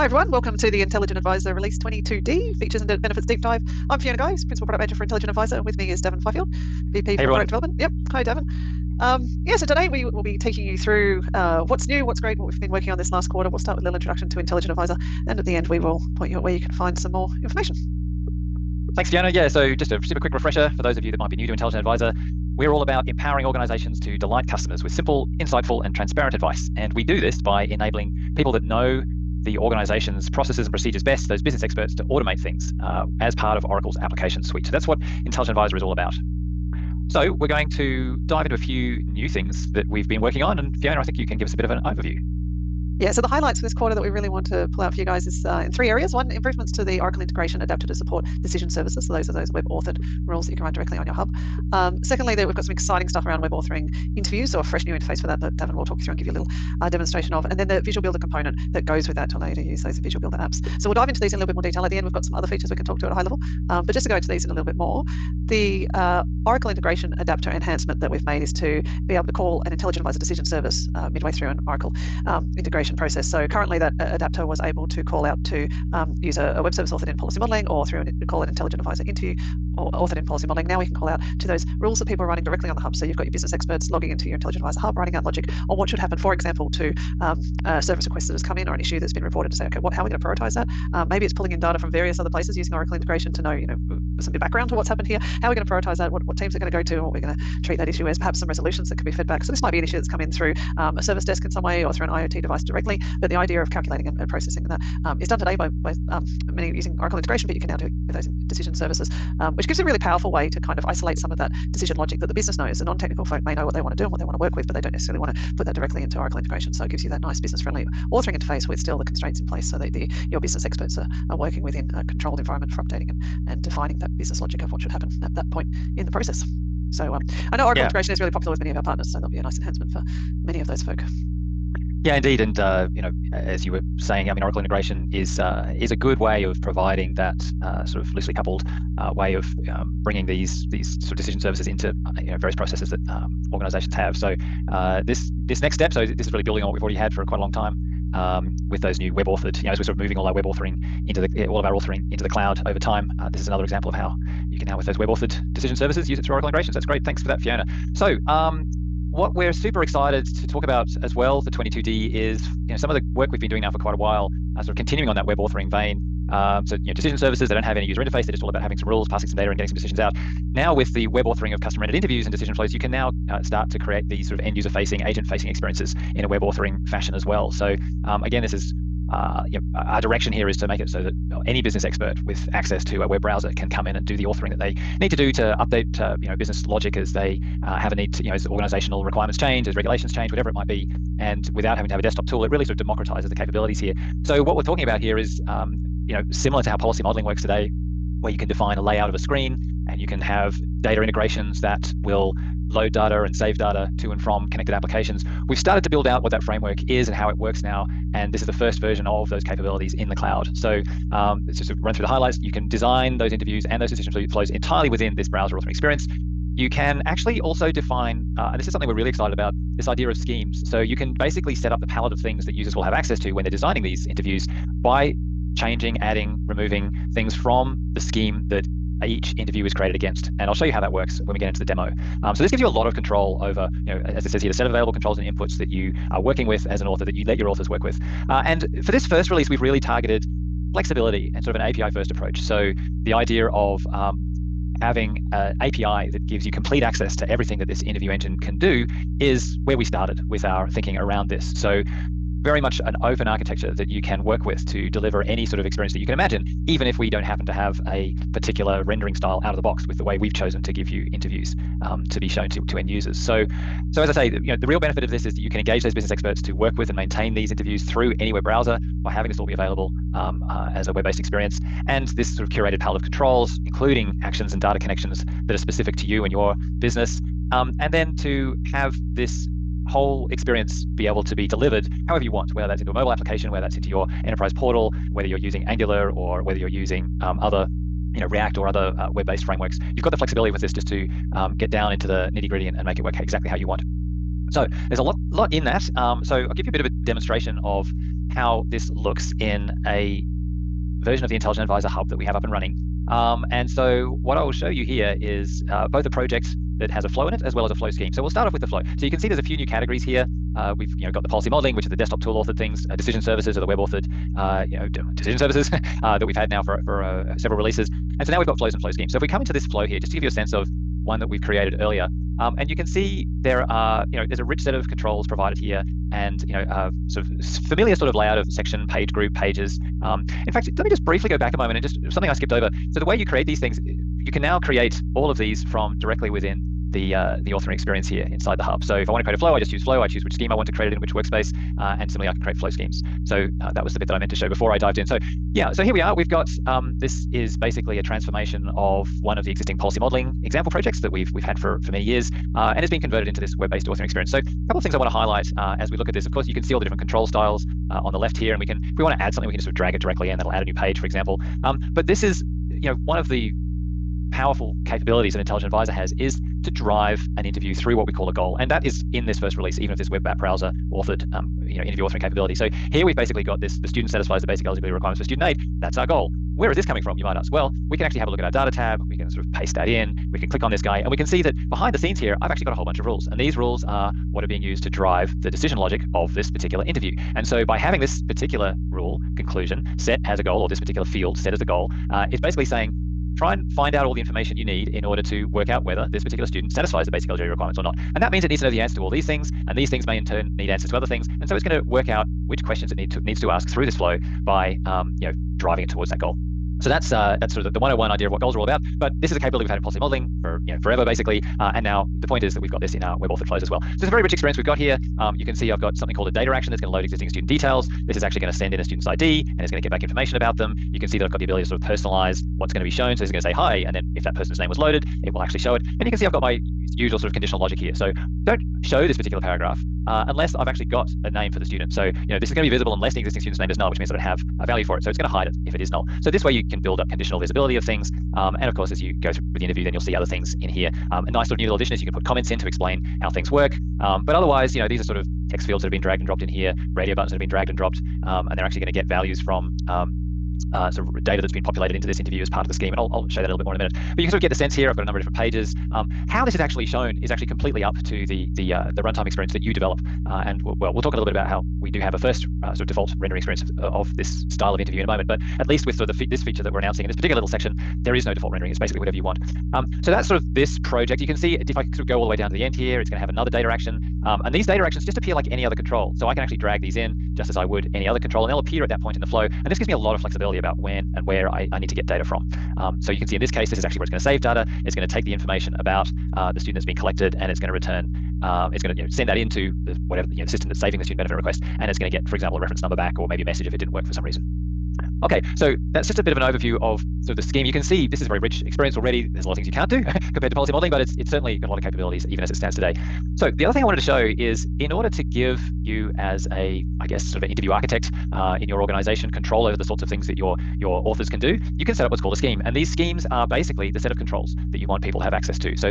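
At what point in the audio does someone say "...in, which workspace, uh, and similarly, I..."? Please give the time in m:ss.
5:40.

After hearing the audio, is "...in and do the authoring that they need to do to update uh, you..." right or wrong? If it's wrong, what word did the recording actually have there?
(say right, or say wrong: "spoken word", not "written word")
right.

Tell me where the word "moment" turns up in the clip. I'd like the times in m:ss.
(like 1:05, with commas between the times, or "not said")
5:31, 7:45.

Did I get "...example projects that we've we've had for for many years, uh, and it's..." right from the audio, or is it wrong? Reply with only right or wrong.
right.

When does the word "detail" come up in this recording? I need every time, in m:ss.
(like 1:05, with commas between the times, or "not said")
1:01, 6:57.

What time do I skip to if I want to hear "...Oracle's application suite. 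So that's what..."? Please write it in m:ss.
0:33.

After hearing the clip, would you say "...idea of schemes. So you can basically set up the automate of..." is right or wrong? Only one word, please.
wrong.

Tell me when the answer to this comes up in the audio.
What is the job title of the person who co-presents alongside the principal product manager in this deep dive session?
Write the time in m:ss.
0:06.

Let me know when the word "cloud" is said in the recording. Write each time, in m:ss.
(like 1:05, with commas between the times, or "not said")
2:32, 3:30.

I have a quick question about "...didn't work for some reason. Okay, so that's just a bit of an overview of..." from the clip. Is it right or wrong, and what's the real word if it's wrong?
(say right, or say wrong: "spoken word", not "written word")
right.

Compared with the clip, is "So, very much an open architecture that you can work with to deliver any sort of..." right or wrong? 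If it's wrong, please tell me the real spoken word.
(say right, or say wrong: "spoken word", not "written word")
right.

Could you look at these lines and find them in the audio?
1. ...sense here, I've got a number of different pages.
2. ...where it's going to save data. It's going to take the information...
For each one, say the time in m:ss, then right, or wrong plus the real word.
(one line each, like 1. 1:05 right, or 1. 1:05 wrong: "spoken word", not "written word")
1. 7:34 right
2. 8:03 right.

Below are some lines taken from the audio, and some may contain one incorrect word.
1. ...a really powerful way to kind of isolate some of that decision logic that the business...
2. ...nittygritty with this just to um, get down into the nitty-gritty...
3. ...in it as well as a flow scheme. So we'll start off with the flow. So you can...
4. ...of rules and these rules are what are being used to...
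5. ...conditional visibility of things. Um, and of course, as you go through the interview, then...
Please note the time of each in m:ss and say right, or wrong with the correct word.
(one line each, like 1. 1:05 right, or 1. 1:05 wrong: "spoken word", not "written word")
1. 1:49 right
2. 4:50 wrong: "flexibility", not "nittygritty"
3. 5:07 right
4. 6:22 right
5. 7:17 right.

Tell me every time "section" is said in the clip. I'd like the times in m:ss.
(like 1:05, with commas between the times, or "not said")
5:28, 7:47.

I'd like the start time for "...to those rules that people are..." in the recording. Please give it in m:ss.
1:21.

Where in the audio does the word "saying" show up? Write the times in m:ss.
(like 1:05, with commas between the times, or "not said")
2:13, 6:32.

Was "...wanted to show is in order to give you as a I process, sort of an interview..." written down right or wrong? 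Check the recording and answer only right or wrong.
wrong.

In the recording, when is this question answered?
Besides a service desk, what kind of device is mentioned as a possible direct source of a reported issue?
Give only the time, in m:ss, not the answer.
1:42.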